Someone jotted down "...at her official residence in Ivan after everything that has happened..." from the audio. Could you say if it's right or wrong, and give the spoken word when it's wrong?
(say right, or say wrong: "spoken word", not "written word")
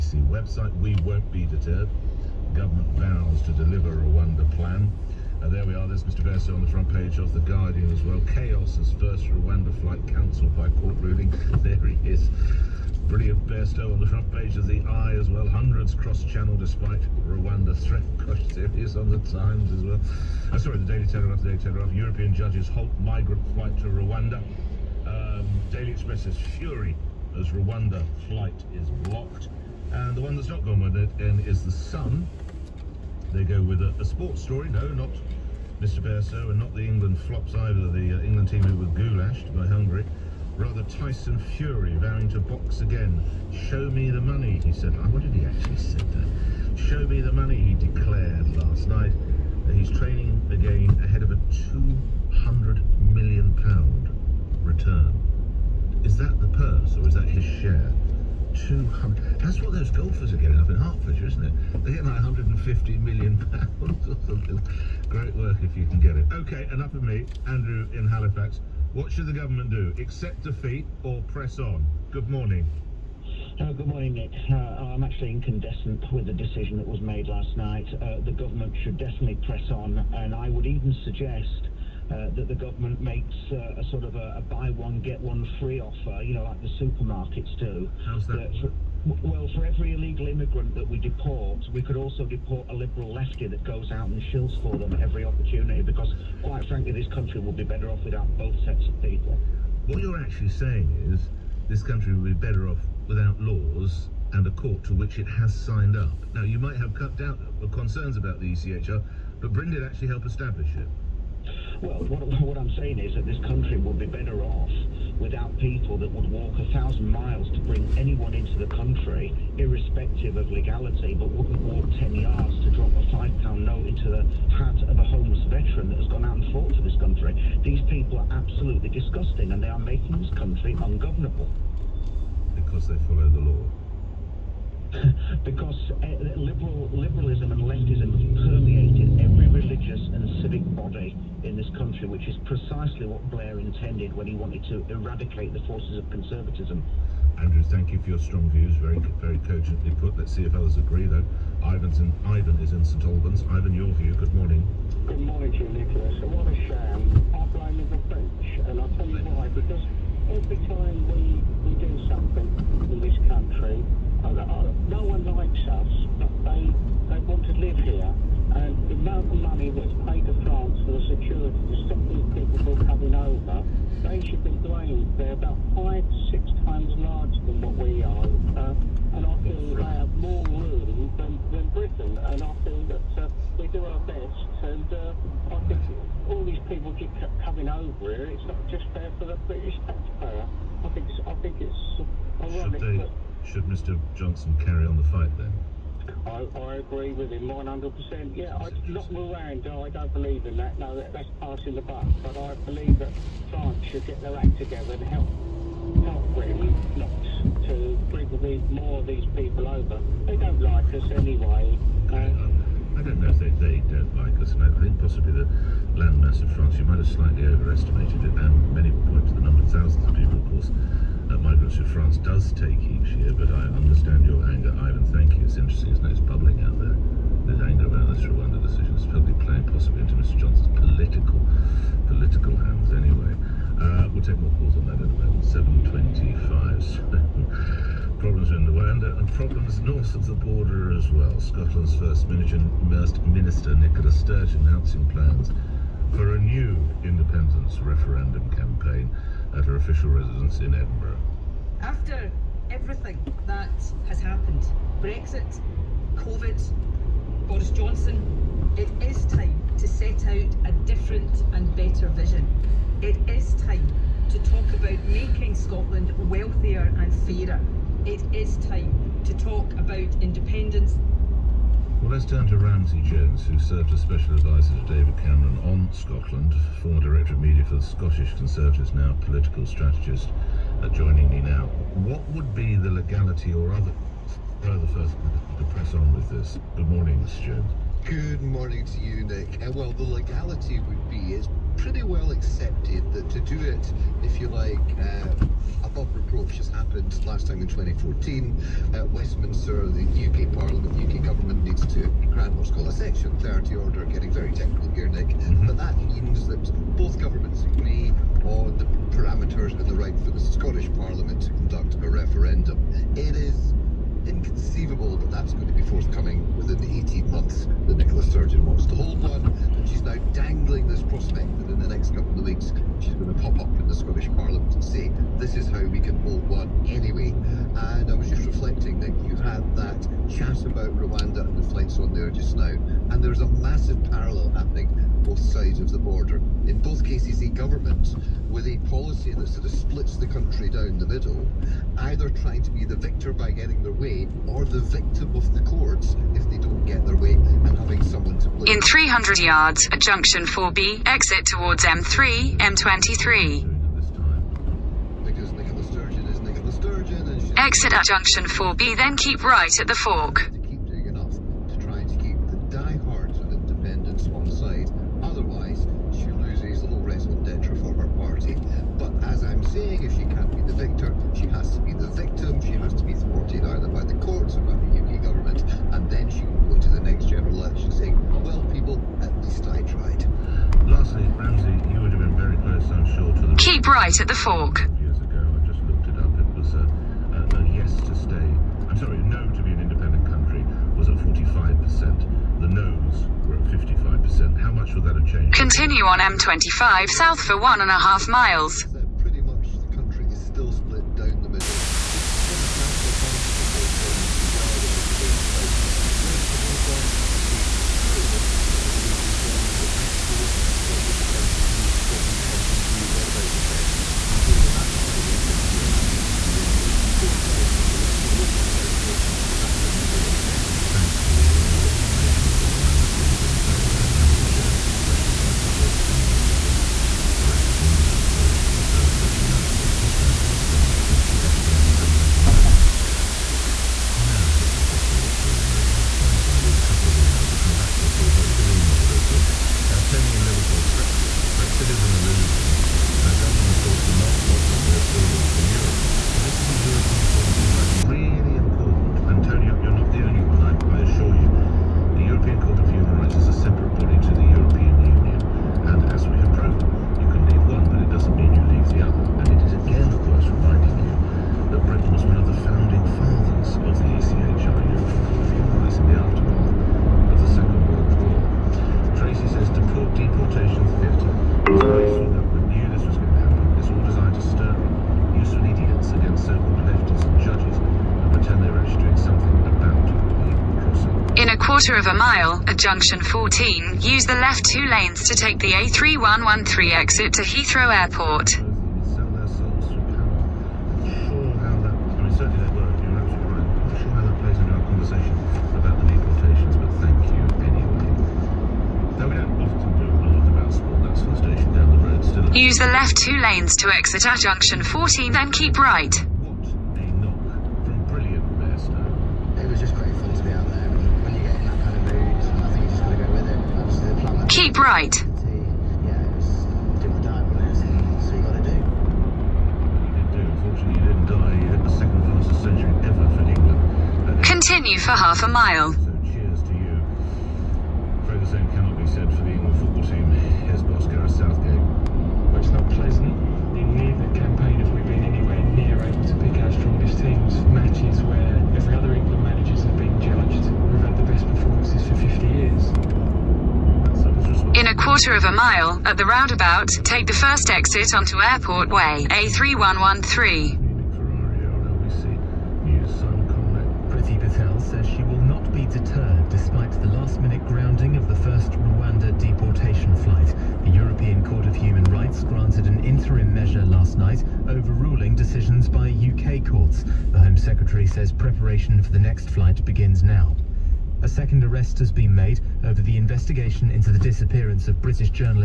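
wrong: "Edinburgh", not "Ivan".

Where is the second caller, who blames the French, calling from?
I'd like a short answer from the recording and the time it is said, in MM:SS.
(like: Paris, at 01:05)
St Albans, at 02:32.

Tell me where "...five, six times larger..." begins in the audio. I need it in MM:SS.
02:55.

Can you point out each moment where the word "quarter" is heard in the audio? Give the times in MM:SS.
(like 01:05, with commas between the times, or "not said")
08:01, 09:05.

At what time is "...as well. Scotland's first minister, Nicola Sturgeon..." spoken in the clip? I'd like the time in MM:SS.
04:00.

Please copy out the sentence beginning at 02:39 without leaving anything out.
Because every time we, we do something in this country, uh, no one likes us, but they, they want to live here.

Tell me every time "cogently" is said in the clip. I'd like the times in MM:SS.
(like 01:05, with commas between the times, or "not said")
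02:29.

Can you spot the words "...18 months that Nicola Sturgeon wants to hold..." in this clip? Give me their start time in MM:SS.
05:17.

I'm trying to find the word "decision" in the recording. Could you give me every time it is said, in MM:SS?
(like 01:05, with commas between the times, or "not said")
01:16, 03:48, 09:25.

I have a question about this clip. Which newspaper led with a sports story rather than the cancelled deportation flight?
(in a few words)
The Sun.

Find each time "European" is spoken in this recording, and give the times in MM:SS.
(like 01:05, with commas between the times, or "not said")
00:21, 09:20.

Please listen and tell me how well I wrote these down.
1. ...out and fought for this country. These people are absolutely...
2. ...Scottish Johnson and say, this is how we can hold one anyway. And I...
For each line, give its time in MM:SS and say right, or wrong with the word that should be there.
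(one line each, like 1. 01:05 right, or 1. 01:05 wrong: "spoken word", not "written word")
1. 02:06 right
2. 05:23 wrong: "Parliament", not "Johnson".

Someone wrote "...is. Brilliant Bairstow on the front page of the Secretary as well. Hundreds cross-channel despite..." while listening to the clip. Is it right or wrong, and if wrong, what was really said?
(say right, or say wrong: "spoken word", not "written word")
wrong: "Eye", not "Secretary".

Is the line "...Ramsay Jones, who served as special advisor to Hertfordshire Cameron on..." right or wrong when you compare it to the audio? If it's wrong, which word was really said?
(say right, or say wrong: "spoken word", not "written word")
wrong: "David", not "Hertfordshire".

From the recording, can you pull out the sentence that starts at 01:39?
What you're actually saying is this country would be better off without laws and a court to which it has signed up.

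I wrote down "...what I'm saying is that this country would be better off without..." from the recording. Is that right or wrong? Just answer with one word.
right.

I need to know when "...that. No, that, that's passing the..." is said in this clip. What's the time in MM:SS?
03:20.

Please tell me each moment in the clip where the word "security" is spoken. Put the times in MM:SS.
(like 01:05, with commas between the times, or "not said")
02:51.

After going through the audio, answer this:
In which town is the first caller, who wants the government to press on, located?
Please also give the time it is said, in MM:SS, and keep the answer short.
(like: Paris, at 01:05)
Halifax, at 01:08.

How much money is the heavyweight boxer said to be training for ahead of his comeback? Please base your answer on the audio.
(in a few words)
£200 million.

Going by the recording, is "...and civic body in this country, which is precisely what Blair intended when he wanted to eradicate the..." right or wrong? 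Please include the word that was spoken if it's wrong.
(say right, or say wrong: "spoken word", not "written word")
right.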